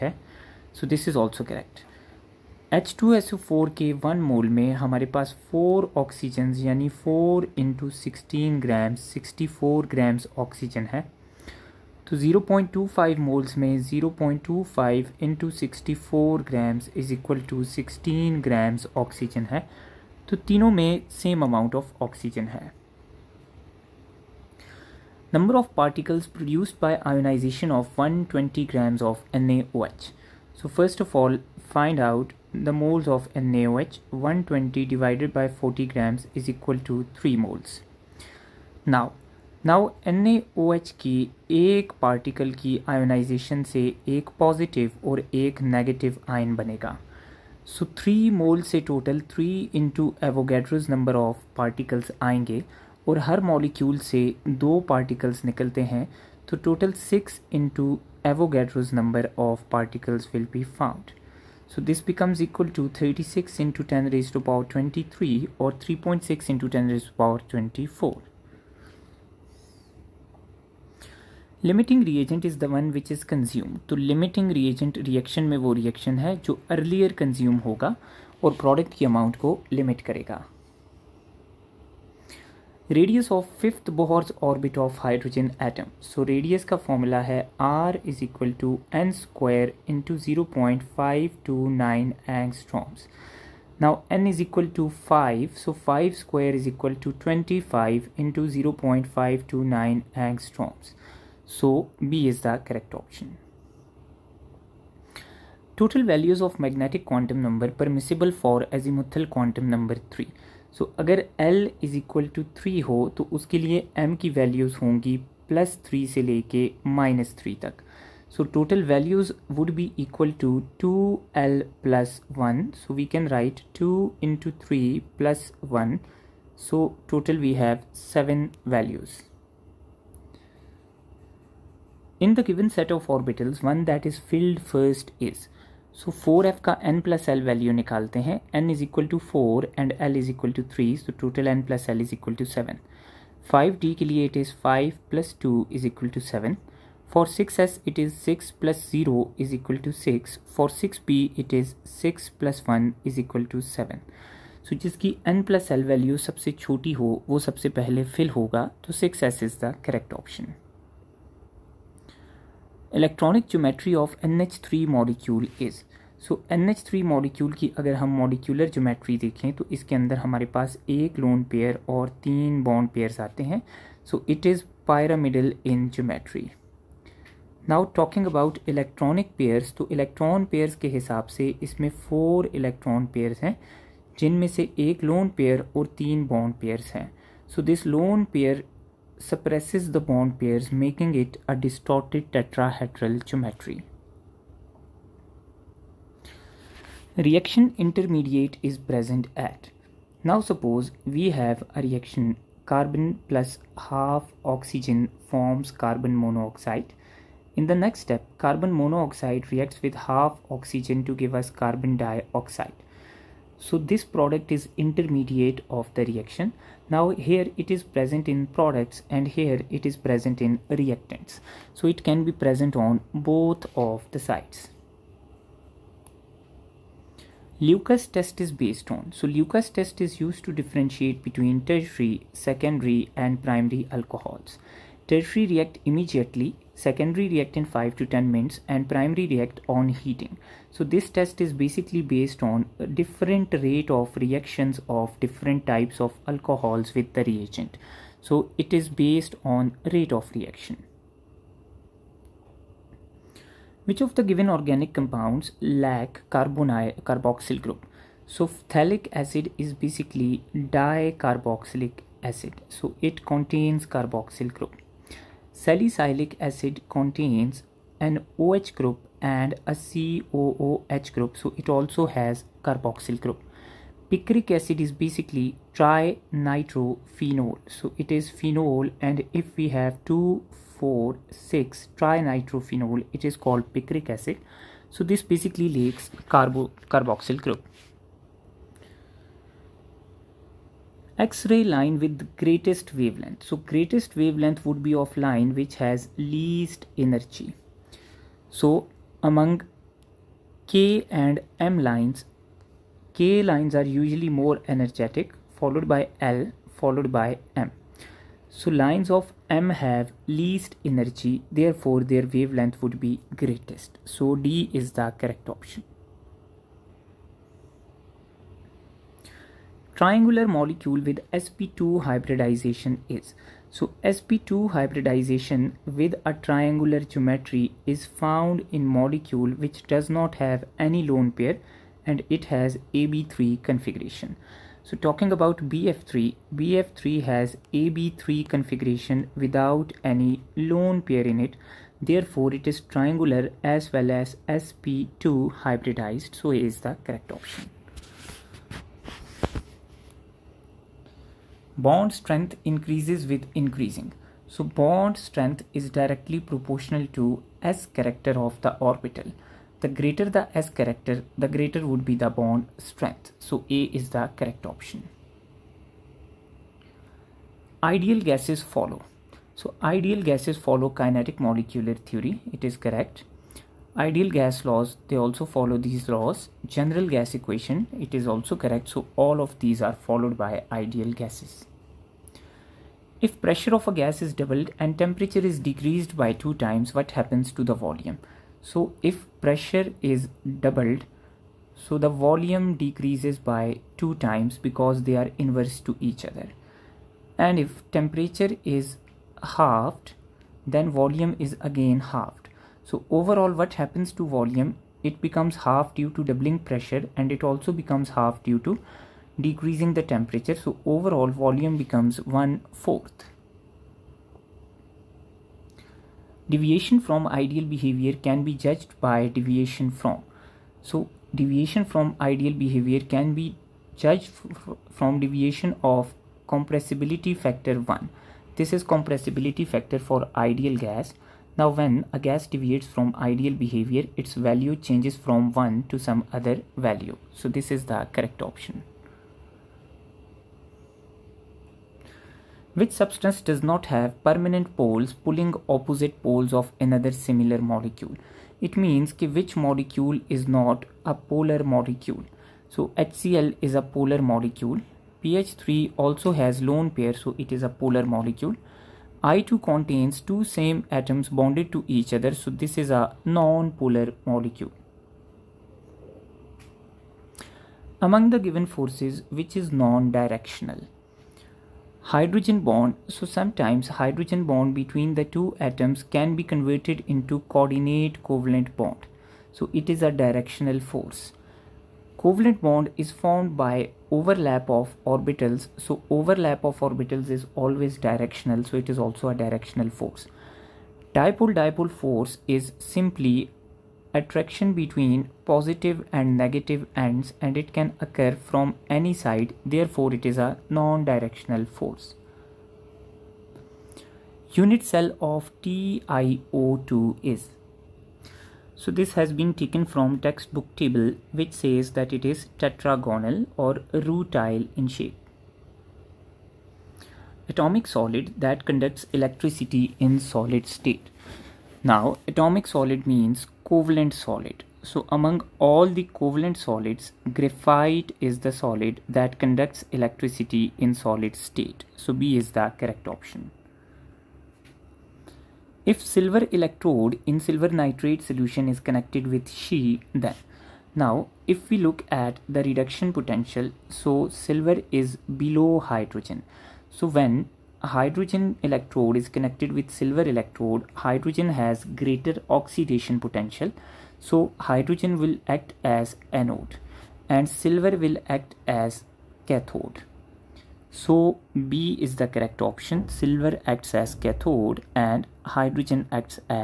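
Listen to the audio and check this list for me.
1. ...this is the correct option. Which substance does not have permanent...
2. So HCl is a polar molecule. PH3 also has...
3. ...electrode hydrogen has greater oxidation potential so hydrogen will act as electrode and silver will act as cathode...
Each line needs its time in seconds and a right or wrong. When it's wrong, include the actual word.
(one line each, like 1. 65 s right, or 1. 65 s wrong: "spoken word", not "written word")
1. 437 s right
2. 452 s right
3. 550 s wrong: "anode", not "electrode".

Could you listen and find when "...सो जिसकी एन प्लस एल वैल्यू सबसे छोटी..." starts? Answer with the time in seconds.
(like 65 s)
154 s.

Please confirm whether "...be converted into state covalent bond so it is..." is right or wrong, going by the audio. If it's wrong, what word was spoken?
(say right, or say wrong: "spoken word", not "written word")
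wrong: "coordinate", not "state".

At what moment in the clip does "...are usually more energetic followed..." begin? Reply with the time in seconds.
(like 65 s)
303 s.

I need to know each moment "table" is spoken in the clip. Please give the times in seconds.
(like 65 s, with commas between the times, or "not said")
510 s.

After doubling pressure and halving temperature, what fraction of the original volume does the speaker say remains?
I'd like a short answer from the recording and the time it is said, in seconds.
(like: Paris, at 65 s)
one fourth, at 412 s.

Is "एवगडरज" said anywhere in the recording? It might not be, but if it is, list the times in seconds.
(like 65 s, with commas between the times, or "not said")
50 s, 58 s.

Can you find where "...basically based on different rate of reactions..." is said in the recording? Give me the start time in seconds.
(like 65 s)
241 s.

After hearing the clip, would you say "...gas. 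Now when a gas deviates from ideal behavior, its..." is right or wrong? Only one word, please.
right.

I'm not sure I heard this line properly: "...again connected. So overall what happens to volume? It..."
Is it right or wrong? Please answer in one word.
wrong.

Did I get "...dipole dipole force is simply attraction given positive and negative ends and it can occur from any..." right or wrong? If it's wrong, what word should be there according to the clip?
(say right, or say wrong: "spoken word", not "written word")
wrong: "between", not "given".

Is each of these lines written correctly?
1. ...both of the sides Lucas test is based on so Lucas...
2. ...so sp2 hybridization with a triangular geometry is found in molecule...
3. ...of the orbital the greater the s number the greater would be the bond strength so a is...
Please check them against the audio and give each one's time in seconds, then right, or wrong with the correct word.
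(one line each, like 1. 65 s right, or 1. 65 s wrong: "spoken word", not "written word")
1. 223 s right
2. 323 s right
3. 358 s wrong: "character", not "number".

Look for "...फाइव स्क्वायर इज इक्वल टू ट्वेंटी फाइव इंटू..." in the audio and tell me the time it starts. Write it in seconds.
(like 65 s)
95 s.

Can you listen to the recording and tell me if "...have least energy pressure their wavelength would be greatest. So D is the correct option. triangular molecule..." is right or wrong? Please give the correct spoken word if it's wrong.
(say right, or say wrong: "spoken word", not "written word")
wrong: "therefore", not "pressure".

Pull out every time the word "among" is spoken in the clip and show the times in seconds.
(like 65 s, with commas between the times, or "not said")
299 s, 468 s, 525 s.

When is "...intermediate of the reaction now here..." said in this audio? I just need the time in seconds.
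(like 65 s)
214 s.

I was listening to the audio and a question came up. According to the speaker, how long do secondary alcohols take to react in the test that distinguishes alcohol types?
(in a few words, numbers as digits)
5 to 10 minutes.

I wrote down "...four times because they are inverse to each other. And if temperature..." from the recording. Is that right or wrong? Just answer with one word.
wrong.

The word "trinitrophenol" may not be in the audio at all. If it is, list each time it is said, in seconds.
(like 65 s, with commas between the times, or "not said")
275 s, 281 s.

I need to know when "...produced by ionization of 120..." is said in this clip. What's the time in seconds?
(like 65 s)
26 s.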